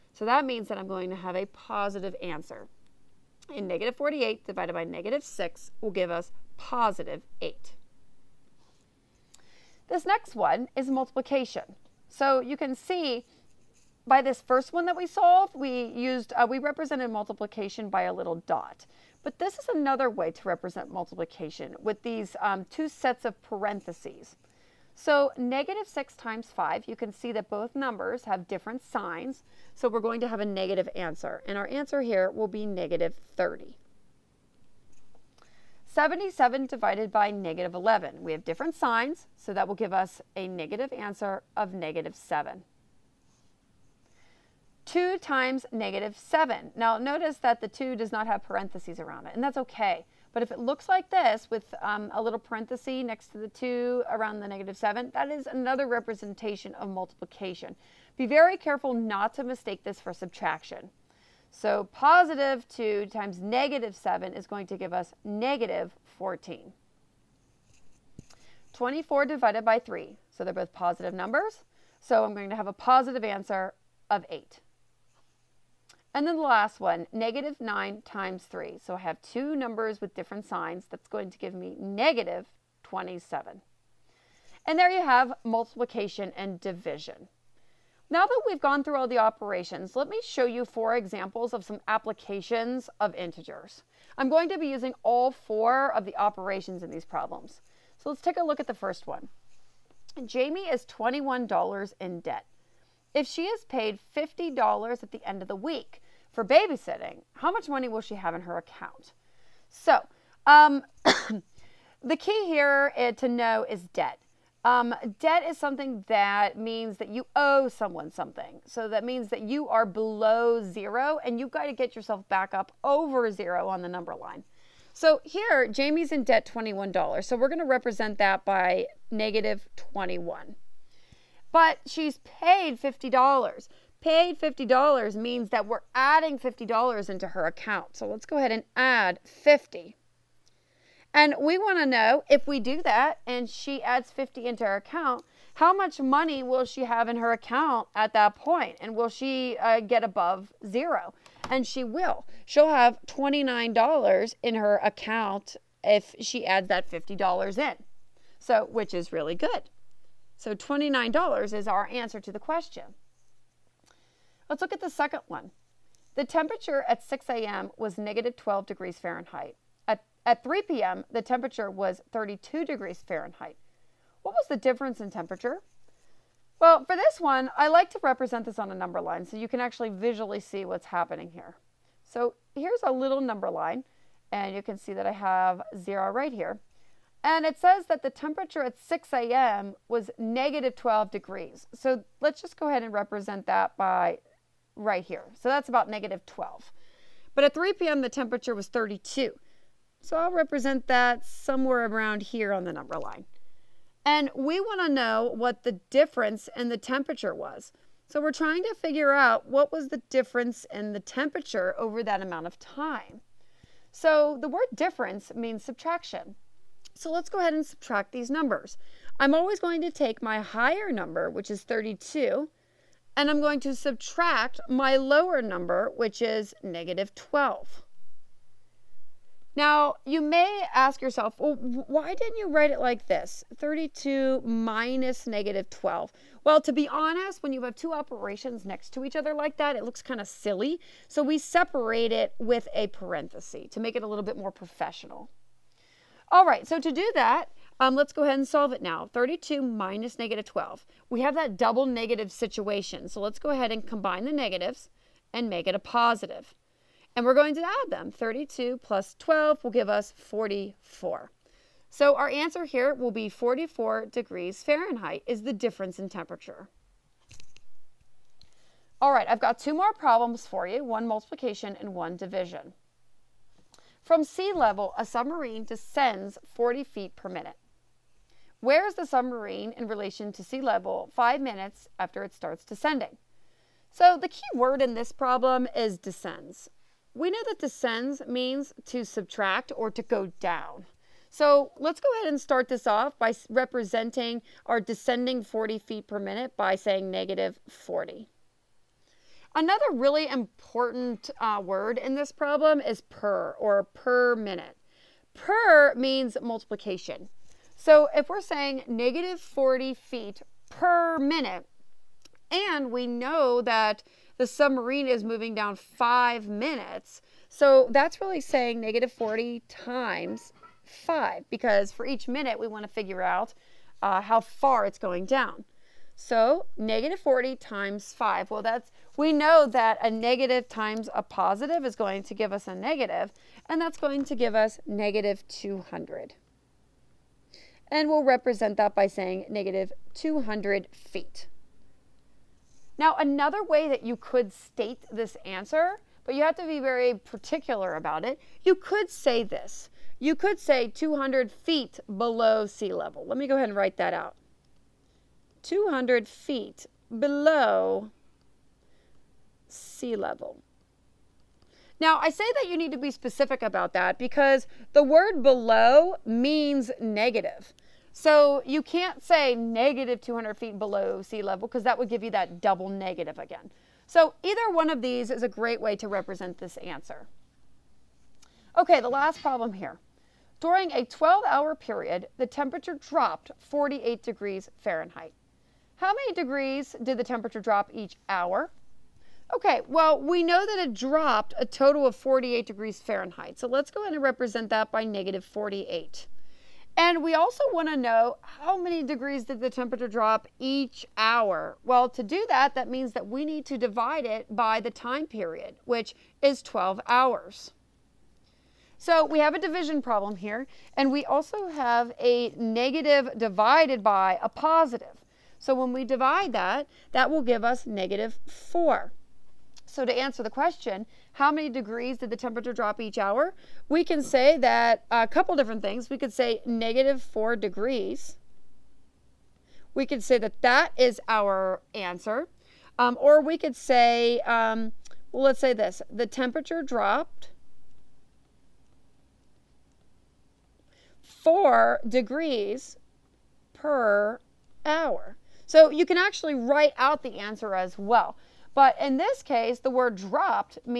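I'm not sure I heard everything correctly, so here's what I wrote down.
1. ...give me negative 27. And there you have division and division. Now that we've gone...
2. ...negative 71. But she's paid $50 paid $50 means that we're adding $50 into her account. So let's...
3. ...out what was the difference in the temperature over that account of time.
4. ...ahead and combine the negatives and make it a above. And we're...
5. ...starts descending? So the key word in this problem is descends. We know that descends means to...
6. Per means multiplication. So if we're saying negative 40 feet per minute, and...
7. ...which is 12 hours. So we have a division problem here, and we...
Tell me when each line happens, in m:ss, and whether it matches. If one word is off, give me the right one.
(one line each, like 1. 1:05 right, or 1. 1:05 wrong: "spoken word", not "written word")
1. 1:21 wrong: "multiplication", not "division"
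2. 2:09 wrong: "21", not "71"
3. 3:29 wrong: "amount", not "account"
4. 4:13 wrong: "positive", not "above"
5. 4:42 right
6. 5:05 right
7. 6:45 right.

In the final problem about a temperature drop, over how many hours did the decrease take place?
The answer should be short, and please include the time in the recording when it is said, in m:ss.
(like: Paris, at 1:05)
12 hours, at 6:21.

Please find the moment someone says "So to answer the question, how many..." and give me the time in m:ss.
6:59.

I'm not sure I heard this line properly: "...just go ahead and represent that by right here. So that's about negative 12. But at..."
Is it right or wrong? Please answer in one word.
right.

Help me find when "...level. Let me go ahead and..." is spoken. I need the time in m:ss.
5:52.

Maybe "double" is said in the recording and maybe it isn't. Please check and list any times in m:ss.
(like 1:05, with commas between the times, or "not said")
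4:11, 6:12.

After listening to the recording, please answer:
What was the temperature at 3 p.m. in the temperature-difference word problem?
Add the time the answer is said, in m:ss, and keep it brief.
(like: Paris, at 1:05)
32 degrees Fahrenheit, at 2:52.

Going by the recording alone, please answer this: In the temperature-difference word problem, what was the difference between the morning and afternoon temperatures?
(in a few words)
44 degrees Fahrenheit.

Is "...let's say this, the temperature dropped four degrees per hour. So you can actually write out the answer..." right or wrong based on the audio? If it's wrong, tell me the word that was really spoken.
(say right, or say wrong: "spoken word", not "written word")
right.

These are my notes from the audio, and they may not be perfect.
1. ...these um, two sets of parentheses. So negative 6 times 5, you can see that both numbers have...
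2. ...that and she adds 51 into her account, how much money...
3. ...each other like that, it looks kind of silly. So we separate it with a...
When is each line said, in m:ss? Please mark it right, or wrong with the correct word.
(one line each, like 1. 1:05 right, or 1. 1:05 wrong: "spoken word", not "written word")
1. 0:22 right
2. 2:22 wrong: "50", not "51"
3. 3:59 right.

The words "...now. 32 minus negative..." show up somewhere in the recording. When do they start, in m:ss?
4:08.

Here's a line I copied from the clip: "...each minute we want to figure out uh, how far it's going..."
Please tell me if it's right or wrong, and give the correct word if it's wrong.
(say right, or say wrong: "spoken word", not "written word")
right.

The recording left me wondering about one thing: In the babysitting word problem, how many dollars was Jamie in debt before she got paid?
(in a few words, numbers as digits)
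$21.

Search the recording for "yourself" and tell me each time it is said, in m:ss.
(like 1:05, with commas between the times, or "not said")
2:01, 3:51.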